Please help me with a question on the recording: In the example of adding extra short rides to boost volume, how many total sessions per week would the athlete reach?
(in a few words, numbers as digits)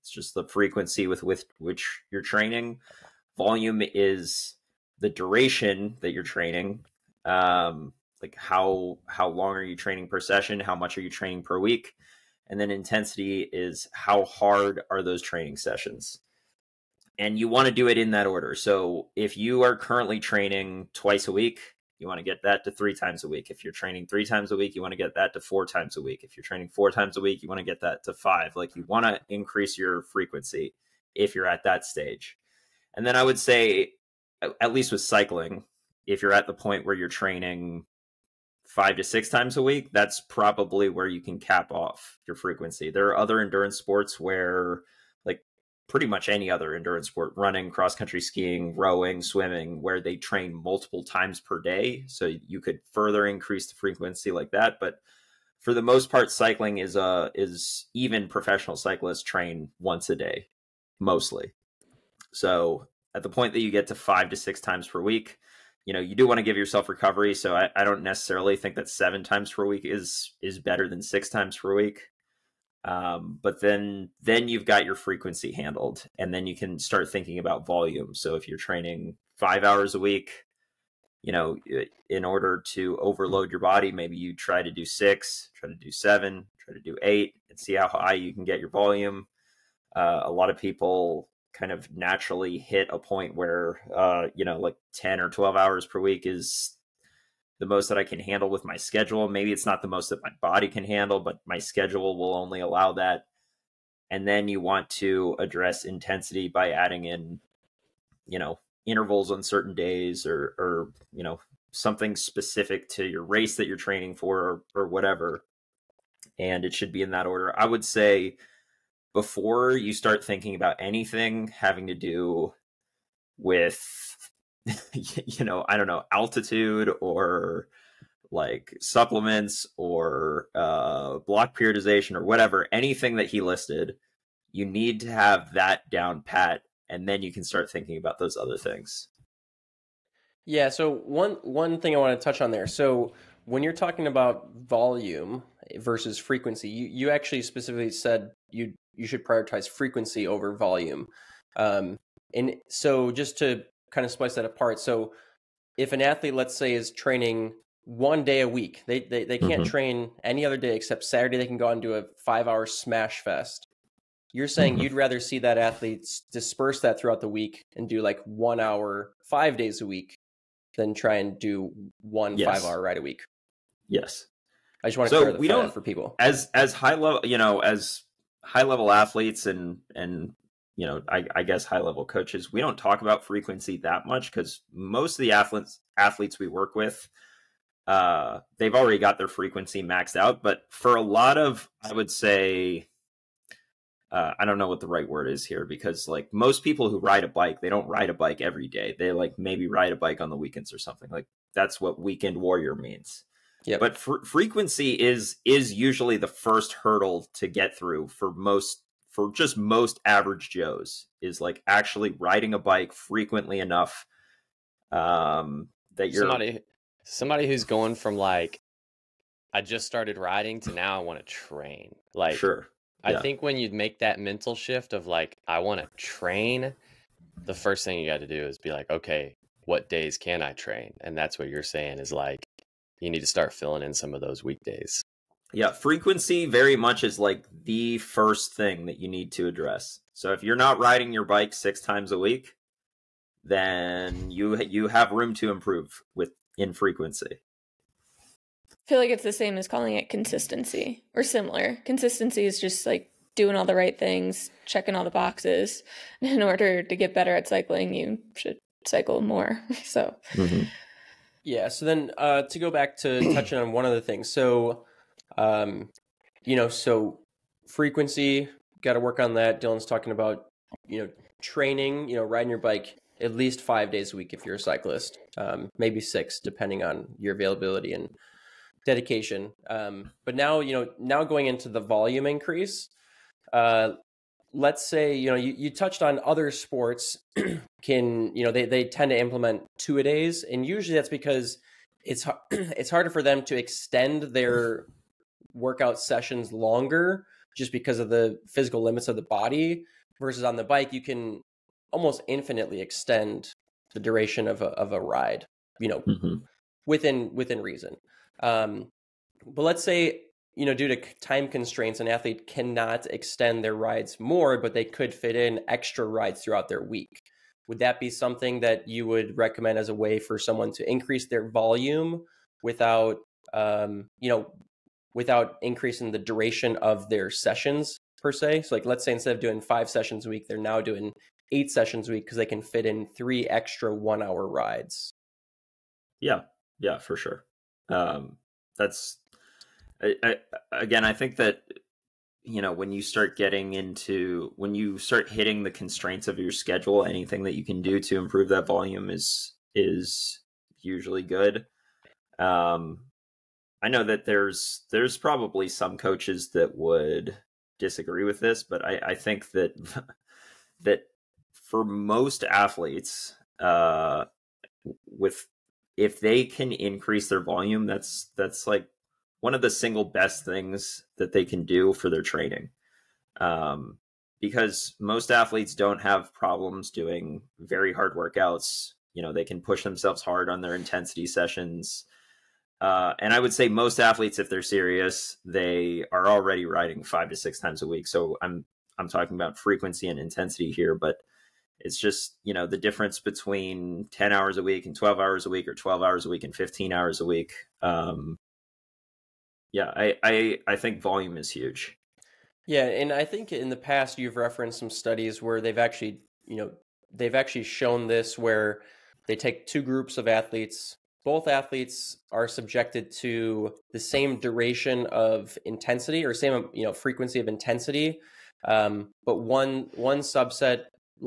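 8.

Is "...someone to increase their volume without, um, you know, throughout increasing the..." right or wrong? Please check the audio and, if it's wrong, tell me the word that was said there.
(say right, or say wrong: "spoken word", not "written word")
wrong: "without", not "throughout".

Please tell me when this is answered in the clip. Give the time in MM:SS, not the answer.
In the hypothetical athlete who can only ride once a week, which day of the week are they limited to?
02:41.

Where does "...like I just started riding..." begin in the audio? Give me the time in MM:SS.
03:38.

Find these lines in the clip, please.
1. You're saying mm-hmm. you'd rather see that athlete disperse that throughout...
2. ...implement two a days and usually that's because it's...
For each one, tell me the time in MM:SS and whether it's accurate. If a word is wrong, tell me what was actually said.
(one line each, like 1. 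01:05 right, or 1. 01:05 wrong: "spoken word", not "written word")
1. 02:44 right
2. 04:49 right.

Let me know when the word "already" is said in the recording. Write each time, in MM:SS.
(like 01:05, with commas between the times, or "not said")
03:08, 06:26.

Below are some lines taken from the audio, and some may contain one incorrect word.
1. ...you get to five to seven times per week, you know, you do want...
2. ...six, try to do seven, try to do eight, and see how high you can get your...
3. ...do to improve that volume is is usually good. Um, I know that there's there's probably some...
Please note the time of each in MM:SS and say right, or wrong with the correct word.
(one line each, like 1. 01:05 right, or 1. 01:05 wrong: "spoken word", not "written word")
1. 01:03 wrong: "six", not "seven"
2. 01:24 right
3. 05:47 right.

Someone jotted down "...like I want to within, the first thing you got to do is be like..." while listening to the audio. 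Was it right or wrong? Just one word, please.
wrong.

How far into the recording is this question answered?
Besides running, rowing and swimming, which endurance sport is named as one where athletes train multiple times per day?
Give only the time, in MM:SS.
00:47.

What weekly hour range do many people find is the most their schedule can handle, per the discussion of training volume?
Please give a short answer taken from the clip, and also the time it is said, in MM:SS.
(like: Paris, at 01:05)
10 or 12 hours, at 01:34.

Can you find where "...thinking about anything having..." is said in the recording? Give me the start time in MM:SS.
02:00.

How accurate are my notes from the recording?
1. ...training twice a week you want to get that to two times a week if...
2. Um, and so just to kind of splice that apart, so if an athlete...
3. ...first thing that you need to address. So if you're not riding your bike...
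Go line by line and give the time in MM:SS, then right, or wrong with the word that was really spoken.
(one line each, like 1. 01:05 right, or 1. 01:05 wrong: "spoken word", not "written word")
1. 00:20 wrong: "three", not "two"
2. 02:31 right
3. 03:57 right.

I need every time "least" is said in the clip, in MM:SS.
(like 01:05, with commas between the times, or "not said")
00:34, 04:33.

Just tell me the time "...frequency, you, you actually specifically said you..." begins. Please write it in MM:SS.
02:26.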